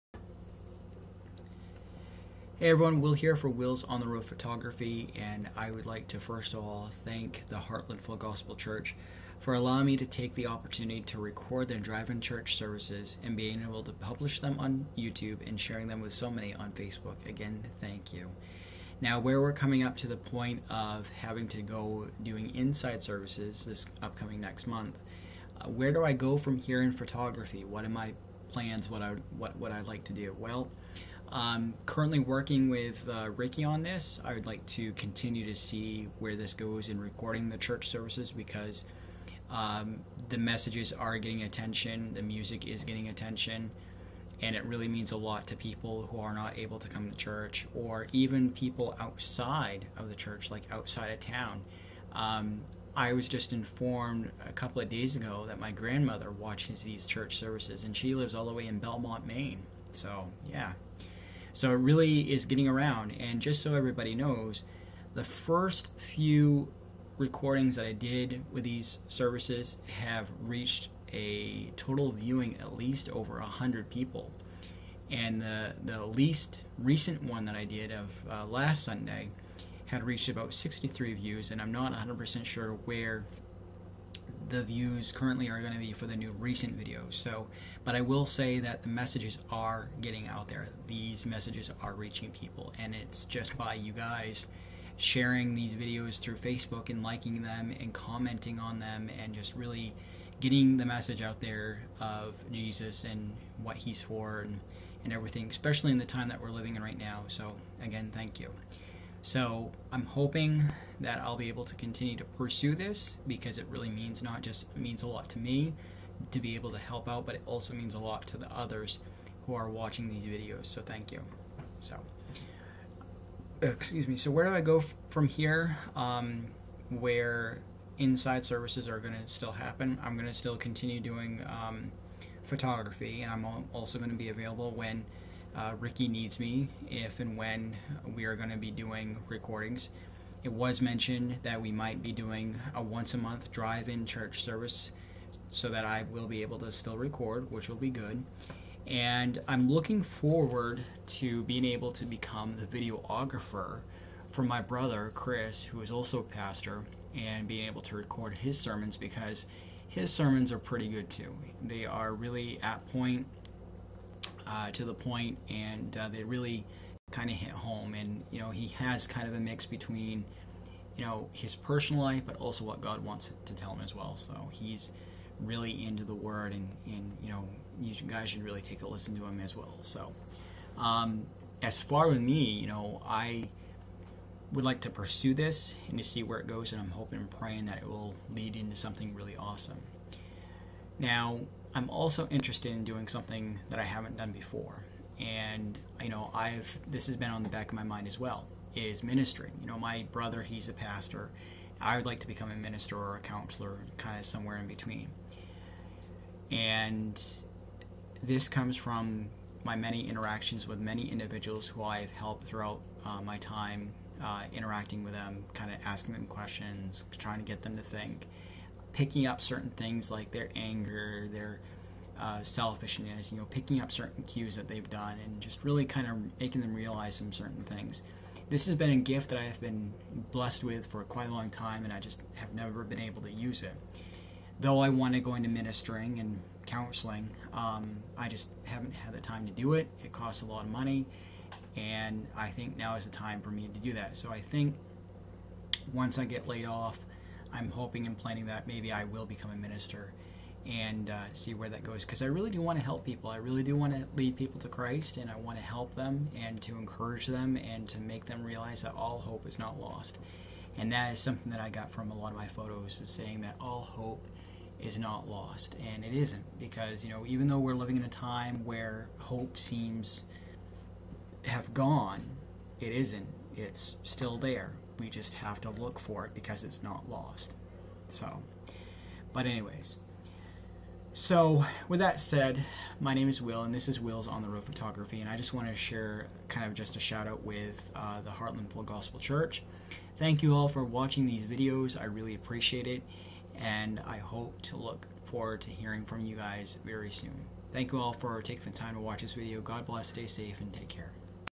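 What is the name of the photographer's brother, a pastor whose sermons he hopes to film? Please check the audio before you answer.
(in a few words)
Chris.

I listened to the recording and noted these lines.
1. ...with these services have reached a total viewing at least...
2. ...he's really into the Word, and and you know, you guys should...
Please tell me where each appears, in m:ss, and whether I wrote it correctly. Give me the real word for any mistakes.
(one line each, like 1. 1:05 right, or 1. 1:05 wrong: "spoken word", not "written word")
1. 1:08 right
2. 2:54 right.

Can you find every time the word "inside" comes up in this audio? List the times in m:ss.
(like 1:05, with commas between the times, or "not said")
0:22, 2:07.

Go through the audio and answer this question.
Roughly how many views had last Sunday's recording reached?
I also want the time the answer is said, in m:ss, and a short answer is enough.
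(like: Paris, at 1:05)
63, at 1:20.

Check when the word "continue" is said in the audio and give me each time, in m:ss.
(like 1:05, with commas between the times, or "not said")
0:34, 1:51, 2:10.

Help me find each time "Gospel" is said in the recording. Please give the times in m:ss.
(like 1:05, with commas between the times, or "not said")
0:08, 4:48.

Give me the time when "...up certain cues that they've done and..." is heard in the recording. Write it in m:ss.
3:43.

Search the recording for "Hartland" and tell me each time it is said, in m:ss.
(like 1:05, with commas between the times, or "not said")
0:07, 4:48.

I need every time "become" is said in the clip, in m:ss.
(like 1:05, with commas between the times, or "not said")
2:32, 3:22, 4:09.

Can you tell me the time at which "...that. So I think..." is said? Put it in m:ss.
4:03.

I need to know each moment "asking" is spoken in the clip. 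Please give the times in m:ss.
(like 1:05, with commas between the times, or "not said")
3:35.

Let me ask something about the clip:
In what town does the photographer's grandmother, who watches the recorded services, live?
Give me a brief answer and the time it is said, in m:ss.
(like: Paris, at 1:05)
Belmont, Maine, at 0:58.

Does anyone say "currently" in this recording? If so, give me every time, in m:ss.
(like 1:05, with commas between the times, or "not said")
0:31, 1:25.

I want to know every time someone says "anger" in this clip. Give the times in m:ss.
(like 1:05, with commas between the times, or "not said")
3:40.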